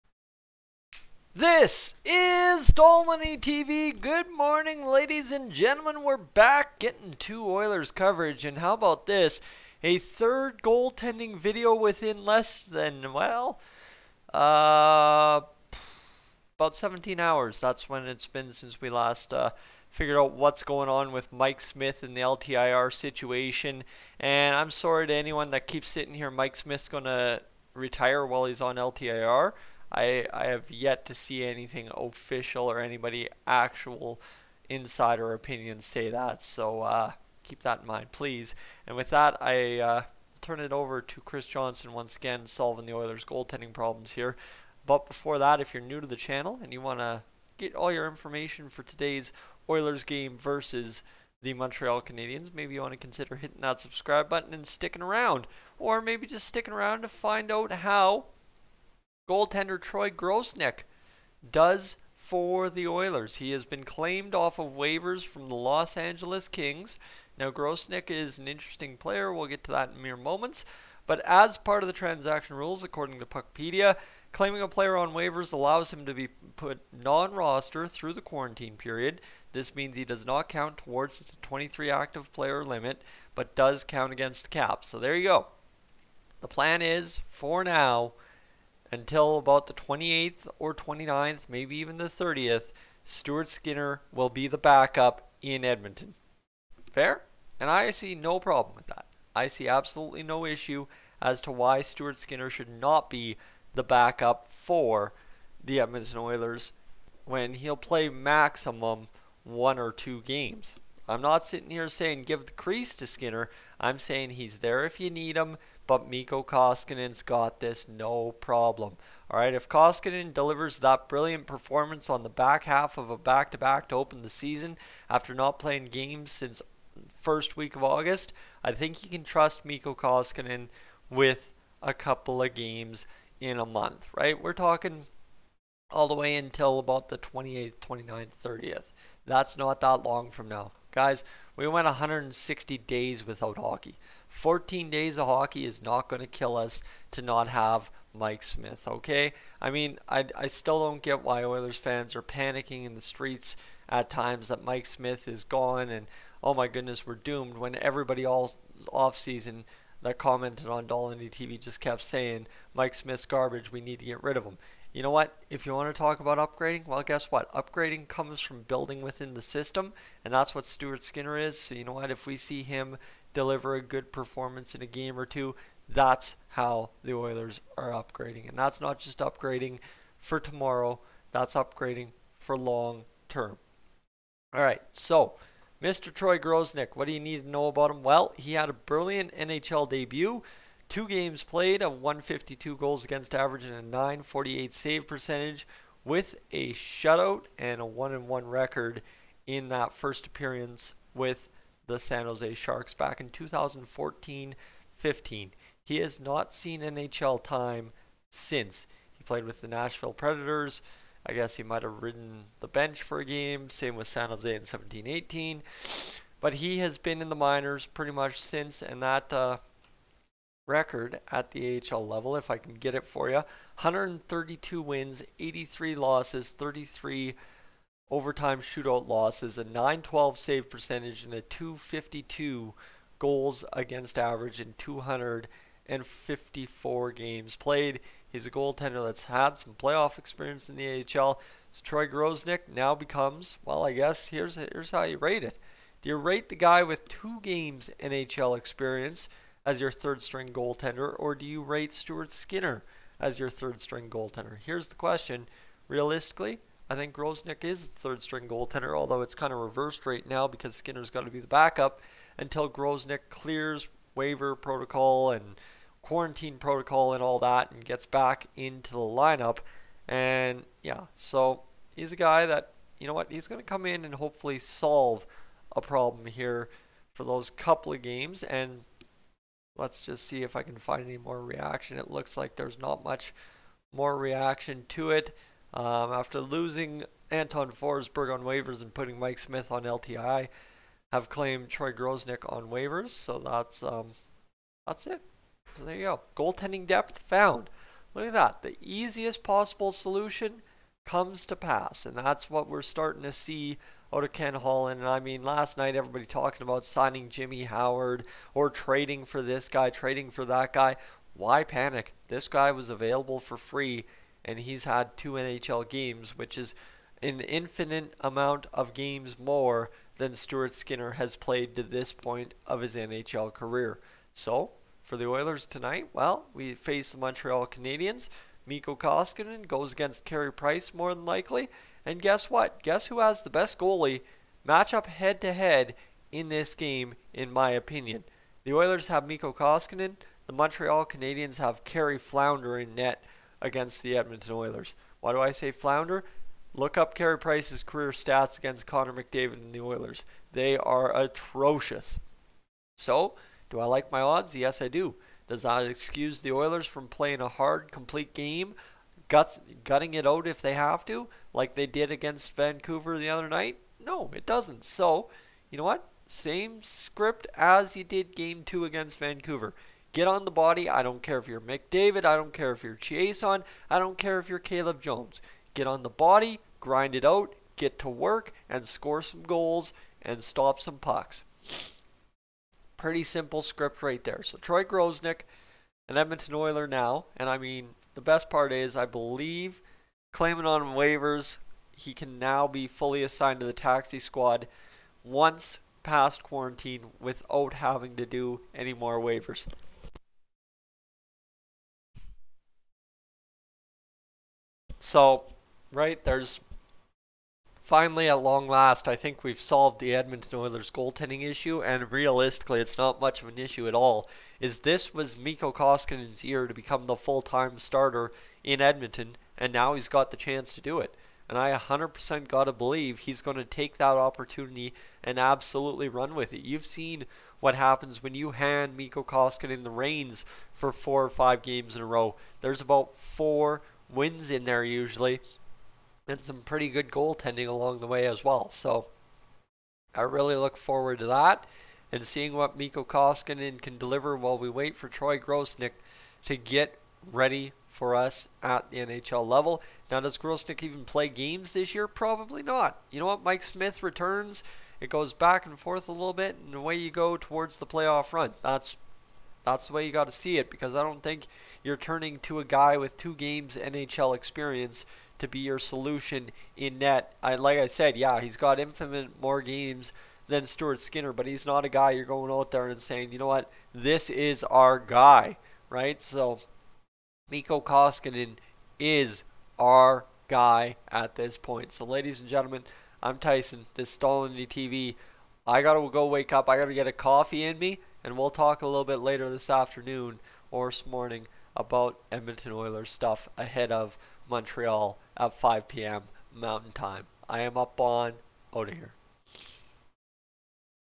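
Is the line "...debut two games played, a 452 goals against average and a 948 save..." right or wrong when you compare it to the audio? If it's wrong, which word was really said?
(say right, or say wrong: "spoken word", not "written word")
wrong: "152", not "452".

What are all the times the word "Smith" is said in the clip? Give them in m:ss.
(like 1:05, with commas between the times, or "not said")
0:21, 0:26, 2:28, 2:34, 2:42, 4:49, 7:33.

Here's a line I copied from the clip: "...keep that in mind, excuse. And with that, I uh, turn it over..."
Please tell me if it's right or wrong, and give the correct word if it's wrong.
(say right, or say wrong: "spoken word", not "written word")
wrong: "please", not "excuse".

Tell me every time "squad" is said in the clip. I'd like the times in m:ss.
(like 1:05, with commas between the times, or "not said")
6:34.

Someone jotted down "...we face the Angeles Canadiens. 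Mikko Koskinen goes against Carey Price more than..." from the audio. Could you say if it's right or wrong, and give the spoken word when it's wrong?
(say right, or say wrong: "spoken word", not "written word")
wrong: "Montreal", not "Angeles".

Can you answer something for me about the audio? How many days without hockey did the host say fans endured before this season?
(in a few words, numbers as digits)
160.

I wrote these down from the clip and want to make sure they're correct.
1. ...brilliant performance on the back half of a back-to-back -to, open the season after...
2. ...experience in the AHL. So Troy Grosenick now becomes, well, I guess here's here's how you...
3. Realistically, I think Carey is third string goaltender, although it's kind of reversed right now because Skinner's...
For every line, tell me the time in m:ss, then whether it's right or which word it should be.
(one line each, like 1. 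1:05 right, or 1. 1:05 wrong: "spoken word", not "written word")
1. 2:01 right
2. 4:00 right
3. 4:15 wrong: "Grosenick", not "Carey".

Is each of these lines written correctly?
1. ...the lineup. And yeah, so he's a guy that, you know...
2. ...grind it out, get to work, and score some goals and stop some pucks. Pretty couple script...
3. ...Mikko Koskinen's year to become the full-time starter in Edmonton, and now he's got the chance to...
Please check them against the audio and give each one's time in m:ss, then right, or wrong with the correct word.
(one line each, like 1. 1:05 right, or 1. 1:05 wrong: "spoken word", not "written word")
1. 4:28 right
2. 6:16 wrong: "simple", not "couple"
3. 6:55 right.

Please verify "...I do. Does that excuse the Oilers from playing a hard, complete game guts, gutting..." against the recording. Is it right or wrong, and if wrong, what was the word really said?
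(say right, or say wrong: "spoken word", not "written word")
right.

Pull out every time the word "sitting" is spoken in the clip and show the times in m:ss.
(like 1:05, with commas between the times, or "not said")
0:25, 1:51.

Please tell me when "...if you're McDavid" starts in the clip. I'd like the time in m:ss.
6:11.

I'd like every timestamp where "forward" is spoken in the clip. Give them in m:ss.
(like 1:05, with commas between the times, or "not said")
7:20.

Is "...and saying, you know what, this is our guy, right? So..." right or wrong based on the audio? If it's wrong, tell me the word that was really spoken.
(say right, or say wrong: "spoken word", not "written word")
right.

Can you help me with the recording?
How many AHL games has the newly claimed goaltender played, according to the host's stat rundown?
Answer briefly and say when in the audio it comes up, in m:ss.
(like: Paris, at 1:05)
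254, at 3:54.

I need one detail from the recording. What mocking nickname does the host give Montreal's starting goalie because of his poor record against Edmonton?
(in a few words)
Carey Flounder.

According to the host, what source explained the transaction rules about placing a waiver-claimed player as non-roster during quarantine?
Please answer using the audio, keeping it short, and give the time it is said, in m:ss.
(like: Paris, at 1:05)
Puckpedia, at 1:13.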